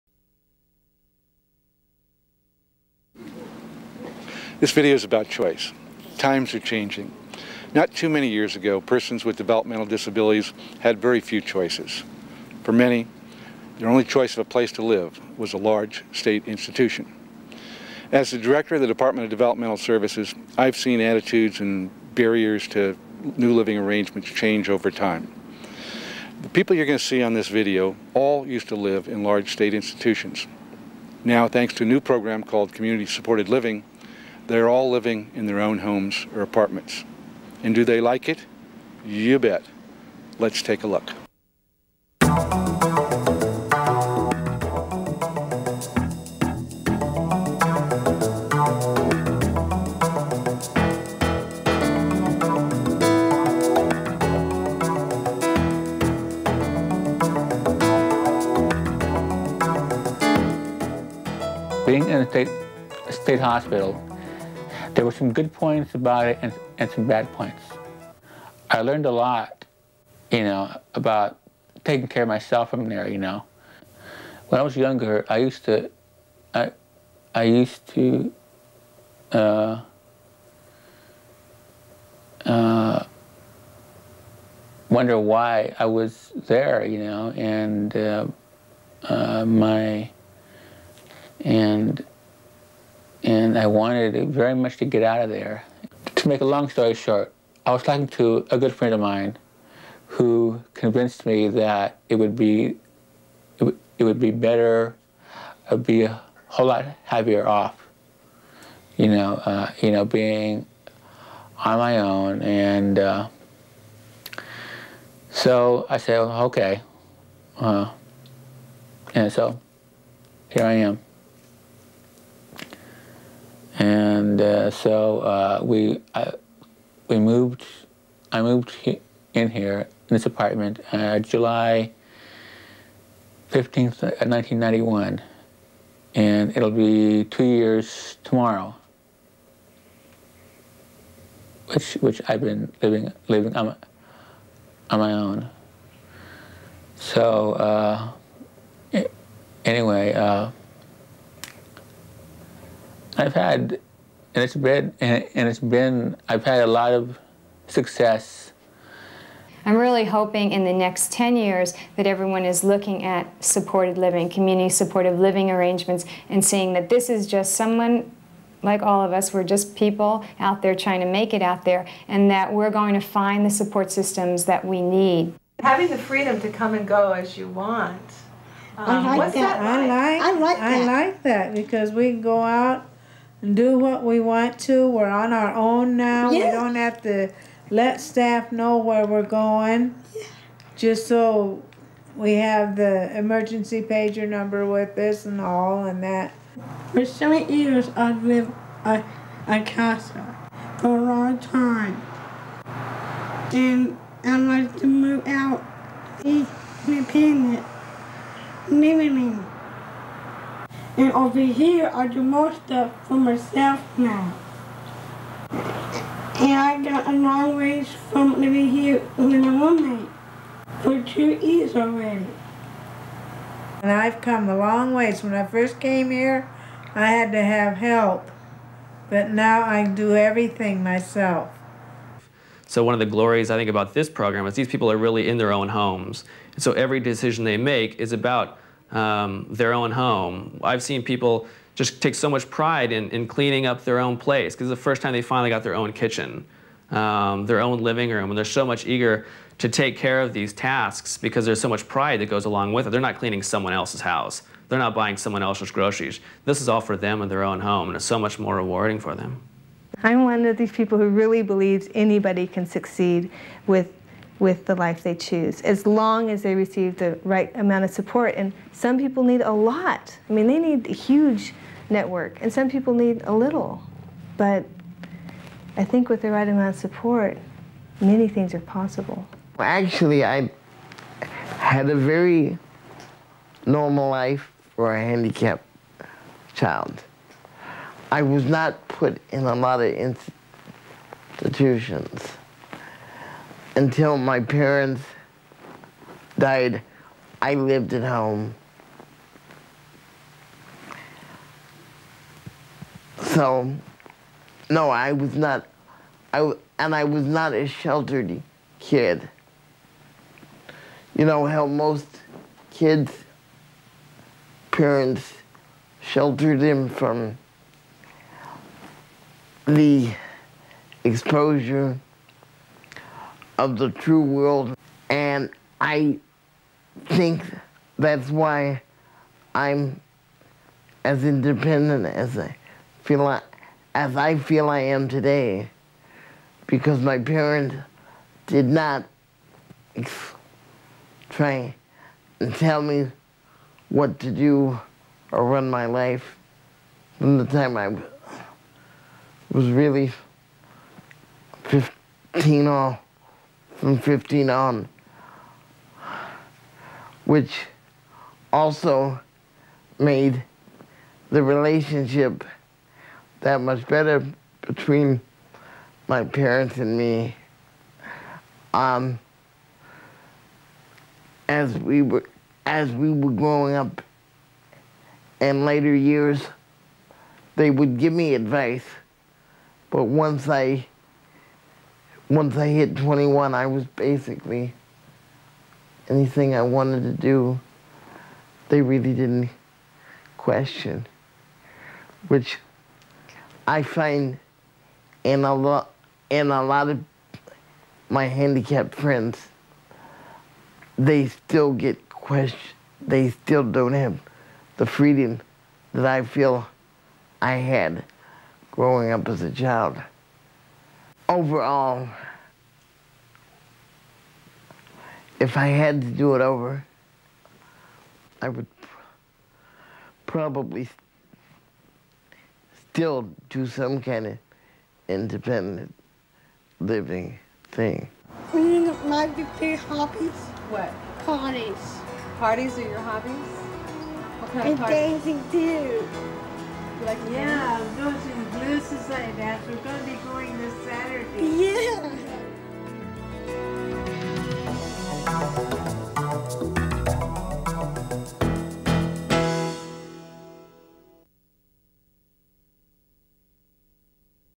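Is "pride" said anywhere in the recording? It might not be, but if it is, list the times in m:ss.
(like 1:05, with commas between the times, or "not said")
4:02, 4:11.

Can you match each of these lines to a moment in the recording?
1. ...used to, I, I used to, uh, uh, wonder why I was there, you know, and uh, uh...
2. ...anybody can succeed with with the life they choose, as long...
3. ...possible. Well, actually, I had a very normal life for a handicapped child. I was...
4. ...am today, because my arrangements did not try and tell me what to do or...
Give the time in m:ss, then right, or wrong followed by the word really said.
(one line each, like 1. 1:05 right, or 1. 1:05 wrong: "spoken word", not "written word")
1. 1:15 right
2. 4:21 right
3. 4:38 right
4. 5:34 wrong: "parents", not "arrangements".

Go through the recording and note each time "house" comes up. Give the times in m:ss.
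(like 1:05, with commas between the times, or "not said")
4:14.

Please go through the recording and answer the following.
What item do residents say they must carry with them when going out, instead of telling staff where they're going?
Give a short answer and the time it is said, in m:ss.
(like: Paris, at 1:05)
emergency pager number, at 3:13.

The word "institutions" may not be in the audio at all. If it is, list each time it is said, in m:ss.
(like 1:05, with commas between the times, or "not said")
0:16, 0:29, 4:51.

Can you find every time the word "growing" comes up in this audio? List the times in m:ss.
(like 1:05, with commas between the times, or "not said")
6:13, 6:48.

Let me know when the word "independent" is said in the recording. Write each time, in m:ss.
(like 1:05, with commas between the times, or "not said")
3:26, 5:31, 7:05.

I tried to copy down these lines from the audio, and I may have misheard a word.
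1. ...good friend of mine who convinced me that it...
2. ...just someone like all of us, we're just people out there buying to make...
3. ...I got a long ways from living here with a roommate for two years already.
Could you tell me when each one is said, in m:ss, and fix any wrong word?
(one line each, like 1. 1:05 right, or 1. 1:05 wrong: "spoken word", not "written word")
1. 1:38 right
2. 2:47 wrong: "trying", not "buying"
3. 3:36 right.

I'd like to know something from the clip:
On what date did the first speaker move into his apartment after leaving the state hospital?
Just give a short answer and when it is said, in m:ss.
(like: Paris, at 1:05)
July 15, 1991, at 2:11.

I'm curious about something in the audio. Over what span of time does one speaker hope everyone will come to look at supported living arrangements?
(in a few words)
10 years.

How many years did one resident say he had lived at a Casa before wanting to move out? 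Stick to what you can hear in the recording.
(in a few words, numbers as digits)
7.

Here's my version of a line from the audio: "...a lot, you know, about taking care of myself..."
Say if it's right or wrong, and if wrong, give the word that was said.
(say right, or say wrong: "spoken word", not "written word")
right.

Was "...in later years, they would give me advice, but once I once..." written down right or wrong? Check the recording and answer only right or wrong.
right.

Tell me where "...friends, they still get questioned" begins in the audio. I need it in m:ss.
6:38.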